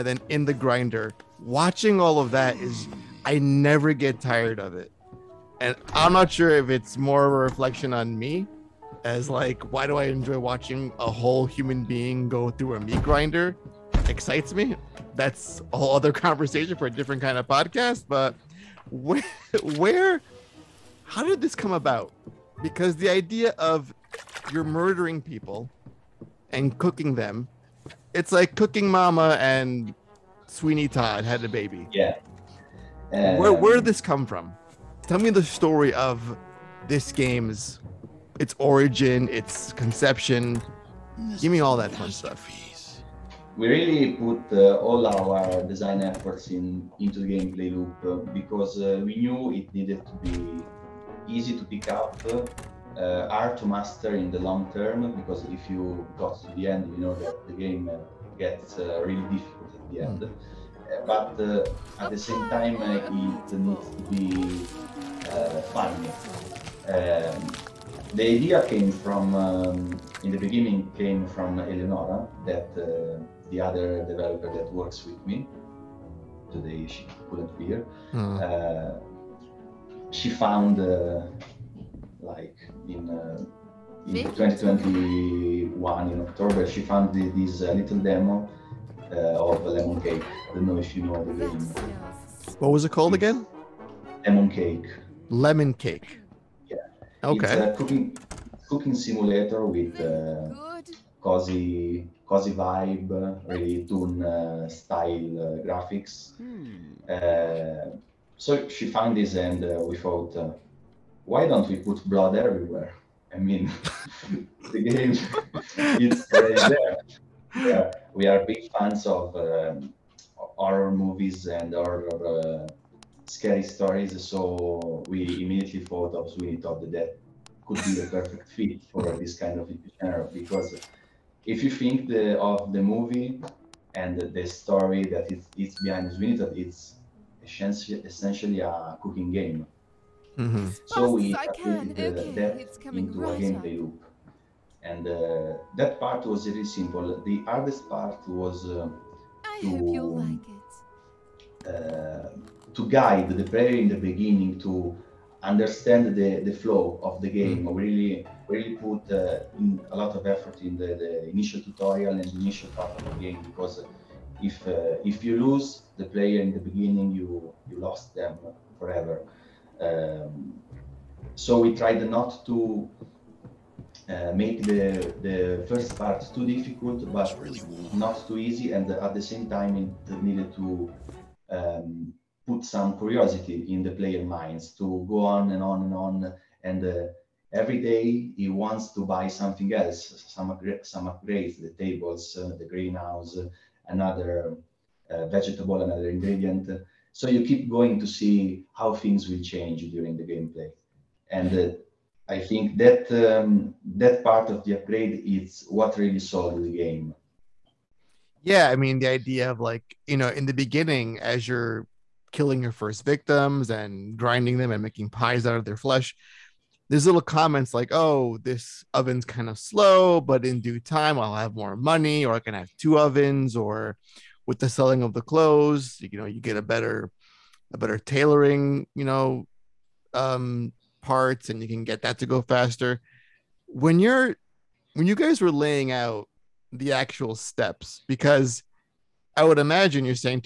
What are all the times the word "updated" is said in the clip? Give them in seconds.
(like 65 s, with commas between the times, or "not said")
141 s.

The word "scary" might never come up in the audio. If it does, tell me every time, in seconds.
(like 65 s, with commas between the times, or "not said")
123 s.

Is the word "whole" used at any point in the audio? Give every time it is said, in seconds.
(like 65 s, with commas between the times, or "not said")
11 s, 15 s.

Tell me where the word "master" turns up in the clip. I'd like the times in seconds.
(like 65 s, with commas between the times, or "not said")
53 s.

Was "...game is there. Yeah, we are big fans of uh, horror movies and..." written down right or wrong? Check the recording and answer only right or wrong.
right.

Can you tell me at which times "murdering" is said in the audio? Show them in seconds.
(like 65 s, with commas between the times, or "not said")
24 s.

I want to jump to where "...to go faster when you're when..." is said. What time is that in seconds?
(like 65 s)
232 s.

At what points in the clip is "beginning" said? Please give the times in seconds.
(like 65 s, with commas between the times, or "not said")
70 s, 153 s, 166 s, 210 s.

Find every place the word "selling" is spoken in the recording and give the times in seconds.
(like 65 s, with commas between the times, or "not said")
224 s.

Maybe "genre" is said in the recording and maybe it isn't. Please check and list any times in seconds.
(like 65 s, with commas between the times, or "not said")
129 s.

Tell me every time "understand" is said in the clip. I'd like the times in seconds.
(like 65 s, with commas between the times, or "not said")
155 s.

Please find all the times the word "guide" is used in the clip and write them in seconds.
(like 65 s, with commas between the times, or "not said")
152 s.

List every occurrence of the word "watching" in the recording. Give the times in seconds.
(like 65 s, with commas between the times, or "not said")
1 s, 10 s.